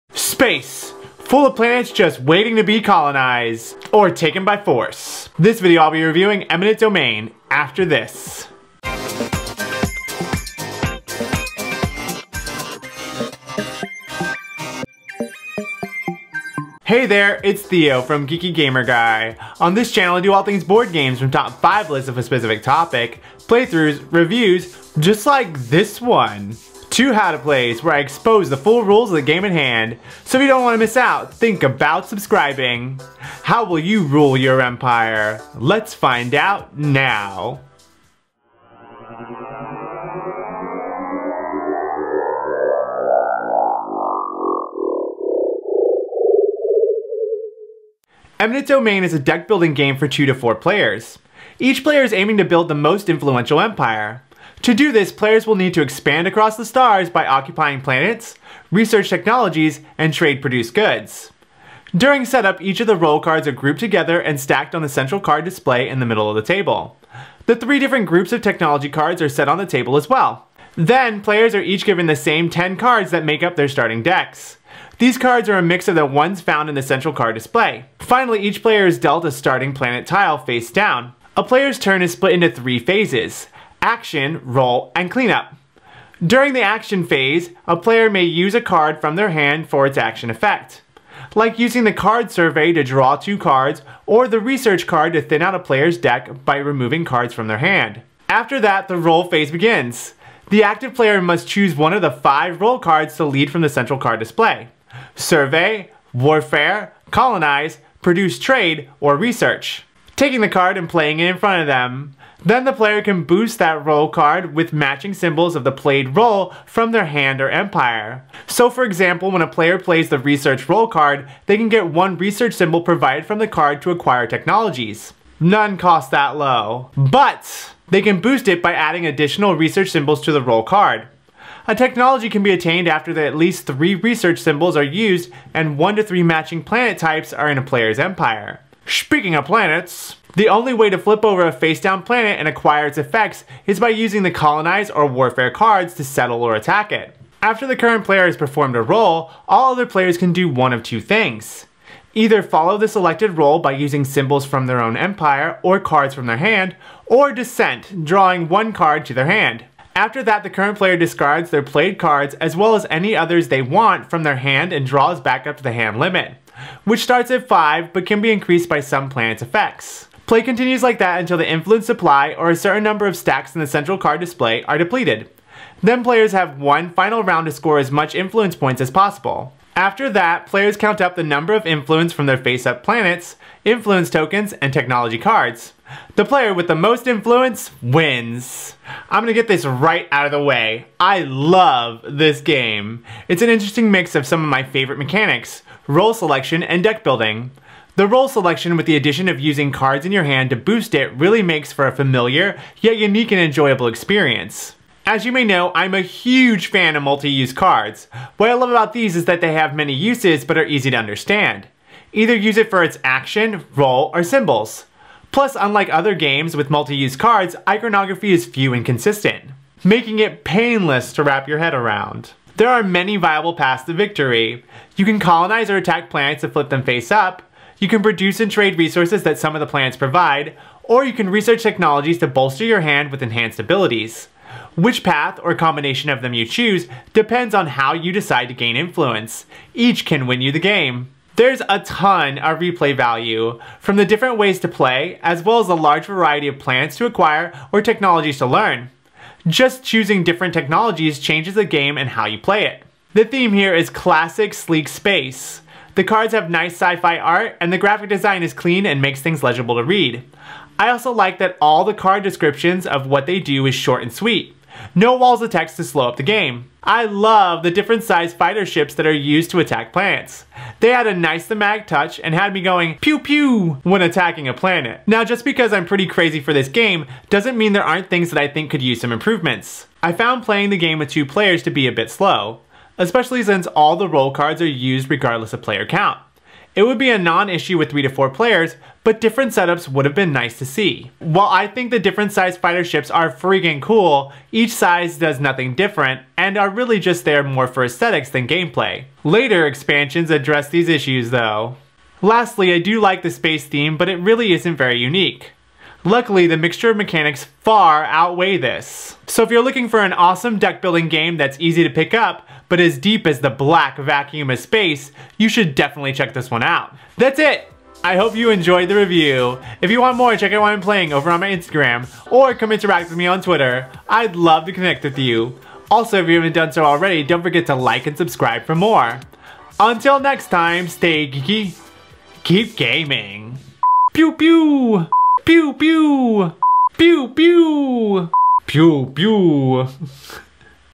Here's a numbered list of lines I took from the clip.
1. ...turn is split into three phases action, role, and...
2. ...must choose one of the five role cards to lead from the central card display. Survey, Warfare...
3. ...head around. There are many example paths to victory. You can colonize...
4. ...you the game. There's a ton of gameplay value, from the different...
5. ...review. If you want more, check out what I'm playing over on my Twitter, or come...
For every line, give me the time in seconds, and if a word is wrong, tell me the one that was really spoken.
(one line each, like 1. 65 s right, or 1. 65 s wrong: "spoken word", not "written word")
1. 81 s right
2. 101 s right
3. 221 s wrong: "viable", not "example"
4. 240 s wrong: "replay", not "gameplay"
5. 318 s wrong: "Instagram", not "Twitter".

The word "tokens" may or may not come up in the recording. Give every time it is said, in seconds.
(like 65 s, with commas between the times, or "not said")
184 s.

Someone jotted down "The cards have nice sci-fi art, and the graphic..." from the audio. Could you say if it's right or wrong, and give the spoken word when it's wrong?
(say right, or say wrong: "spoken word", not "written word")
right.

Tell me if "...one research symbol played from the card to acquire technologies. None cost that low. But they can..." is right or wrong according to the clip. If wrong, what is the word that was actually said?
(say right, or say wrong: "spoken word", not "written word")
wrong: "provided", not "played".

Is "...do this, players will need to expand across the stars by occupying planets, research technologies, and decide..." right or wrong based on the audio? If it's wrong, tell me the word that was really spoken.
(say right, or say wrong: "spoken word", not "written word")
wrong: "trade", not "decide".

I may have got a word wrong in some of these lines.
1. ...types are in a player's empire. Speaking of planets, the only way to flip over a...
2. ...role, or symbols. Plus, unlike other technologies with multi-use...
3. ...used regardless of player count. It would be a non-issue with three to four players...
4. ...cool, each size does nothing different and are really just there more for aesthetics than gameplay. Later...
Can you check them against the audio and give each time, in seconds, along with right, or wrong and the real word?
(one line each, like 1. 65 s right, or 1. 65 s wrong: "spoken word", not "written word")
1. 136 s right
2. 213 s wrong: "games", not "technologies"
3. 284 s right
4. 293 s right.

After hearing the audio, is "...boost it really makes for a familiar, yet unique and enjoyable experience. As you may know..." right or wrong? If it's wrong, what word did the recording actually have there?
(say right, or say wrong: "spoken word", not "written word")
right.